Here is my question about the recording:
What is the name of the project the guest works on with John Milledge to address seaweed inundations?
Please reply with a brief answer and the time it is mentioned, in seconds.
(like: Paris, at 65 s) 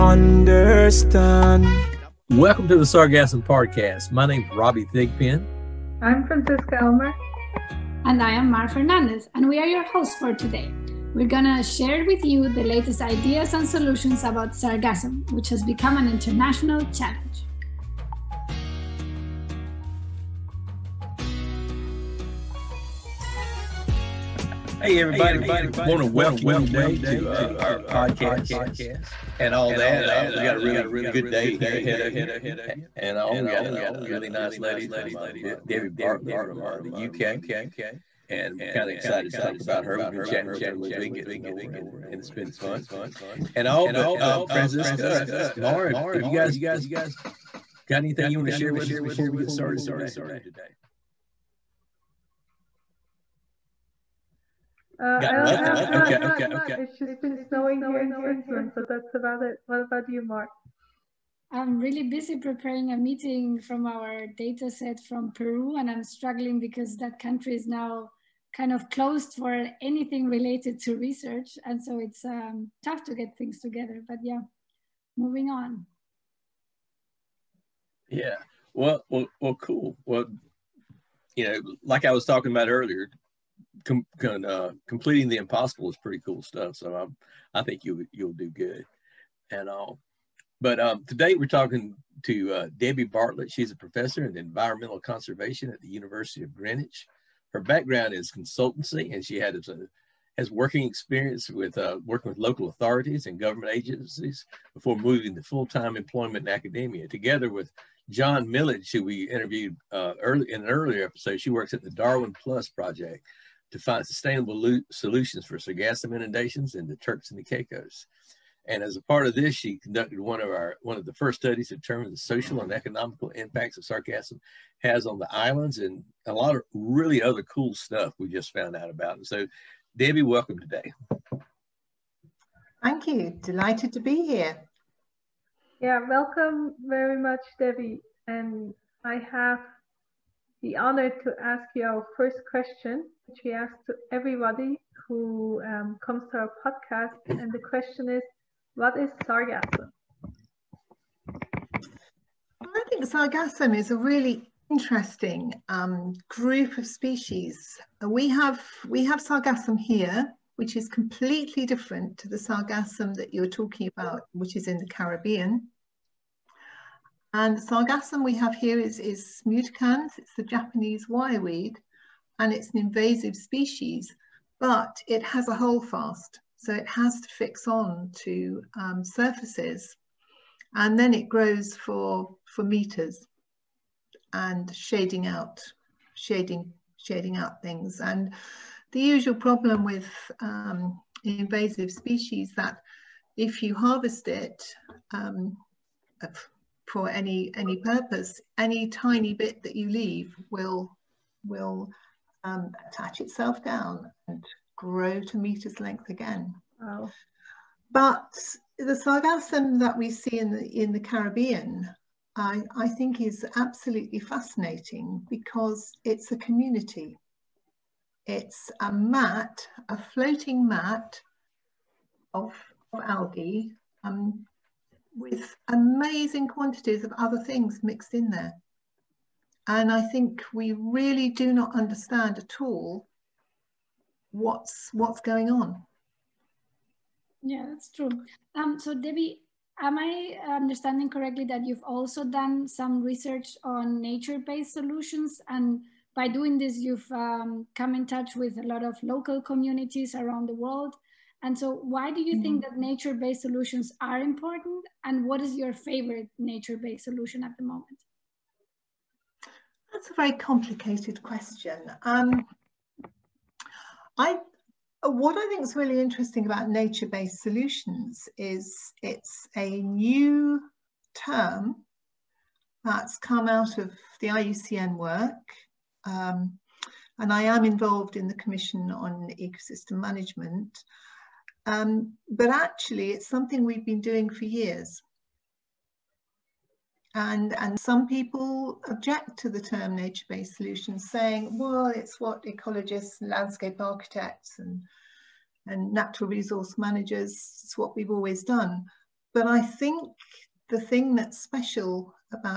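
Darwin Plus Project, at 111 s.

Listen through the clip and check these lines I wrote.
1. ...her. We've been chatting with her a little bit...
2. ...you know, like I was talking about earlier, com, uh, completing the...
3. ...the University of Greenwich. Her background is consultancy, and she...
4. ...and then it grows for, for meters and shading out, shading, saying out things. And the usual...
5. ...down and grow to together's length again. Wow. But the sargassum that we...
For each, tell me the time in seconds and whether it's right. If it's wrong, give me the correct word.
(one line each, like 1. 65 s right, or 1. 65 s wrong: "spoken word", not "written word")
1. 39 s right
2. 81 s right
3. 95 s right
4. 180 s wrong: "shading", not "saying"
5. 203 s wrong: "meter", not "together".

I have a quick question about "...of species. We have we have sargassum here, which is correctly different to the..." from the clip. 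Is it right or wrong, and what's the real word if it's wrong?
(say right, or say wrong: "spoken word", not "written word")
wrong: "completely", not "correctly".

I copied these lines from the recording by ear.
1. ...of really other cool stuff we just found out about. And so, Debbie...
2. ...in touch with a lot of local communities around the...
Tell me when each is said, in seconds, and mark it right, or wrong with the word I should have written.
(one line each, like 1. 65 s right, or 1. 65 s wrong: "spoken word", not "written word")
1. 126 s right
2. 247 s right.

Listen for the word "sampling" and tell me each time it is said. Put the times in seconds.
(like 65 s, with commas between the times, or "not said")
not said.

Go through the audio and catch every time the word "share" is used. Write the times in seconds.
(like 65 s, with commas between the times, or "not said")
11 s, 48 s.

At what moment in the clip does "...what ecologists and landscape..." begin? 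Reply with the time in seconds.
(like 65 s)
292 s.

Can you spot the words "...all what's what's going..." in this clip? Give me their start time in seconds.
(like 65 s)
232 s.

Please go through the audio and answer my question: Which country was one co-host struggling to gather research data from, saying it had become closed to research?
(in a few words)
Peru.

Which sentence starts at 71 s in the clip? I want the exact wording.
And so it's um, tough to get things together.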